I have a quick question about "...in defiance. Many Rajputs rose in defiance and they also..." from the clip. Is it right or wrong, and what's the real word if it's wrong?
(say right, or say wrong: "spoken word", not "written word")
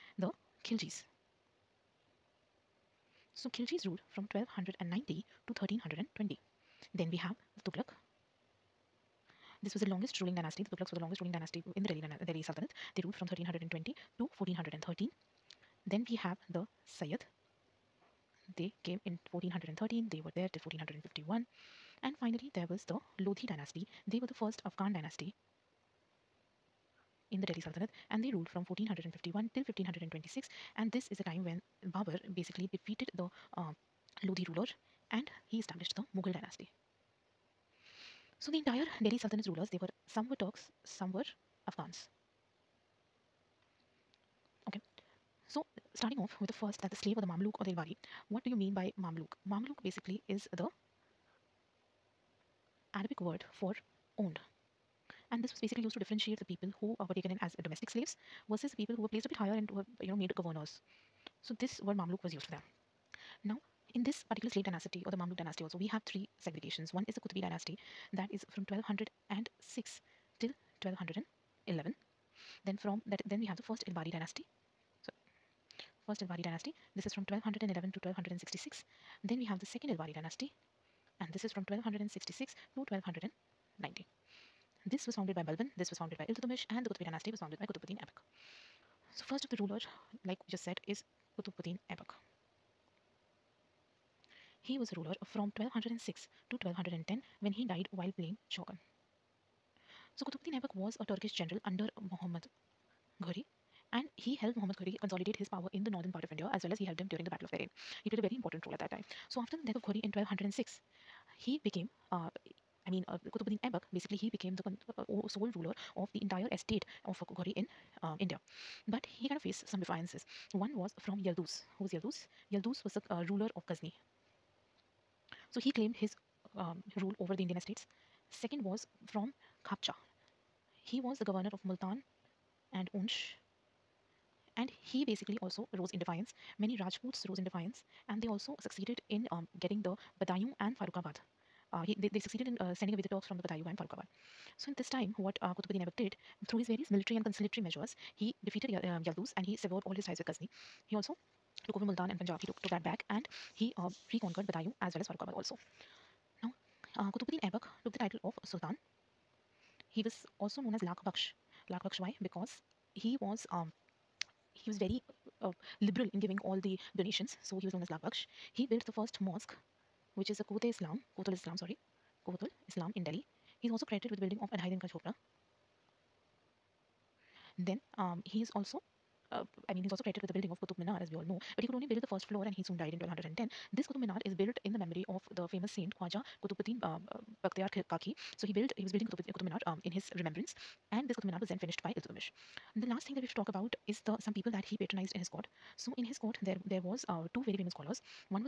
right.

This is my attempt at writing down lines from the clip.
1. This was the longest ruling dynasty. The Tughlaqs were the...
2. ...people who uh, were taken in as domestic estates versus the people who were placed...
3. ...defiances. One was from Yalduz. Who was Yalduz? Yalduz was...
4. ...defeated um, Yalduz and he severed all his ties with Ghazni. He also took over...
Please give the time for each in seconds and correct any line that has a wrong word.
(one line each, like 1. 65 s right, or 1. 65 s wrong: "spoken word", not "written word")
1. 9 s right
2. 56 s wrong: "slaves", not "estates"
3. 119 s right
4. 148 s right.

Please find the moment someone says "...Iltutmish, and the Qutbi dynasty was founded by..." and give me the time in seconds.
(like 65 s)
86 s.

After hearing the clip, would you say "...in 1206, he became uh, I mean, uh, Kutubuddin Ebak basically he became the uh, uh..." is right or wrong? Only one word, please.
right.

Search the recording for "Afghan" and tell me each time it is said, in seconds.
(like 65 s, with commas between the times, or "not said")
24 s, 41 s.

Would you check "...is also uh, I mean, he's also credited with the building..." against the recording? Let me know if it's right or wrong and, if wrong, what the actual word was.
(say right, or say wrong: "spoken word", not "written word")
right.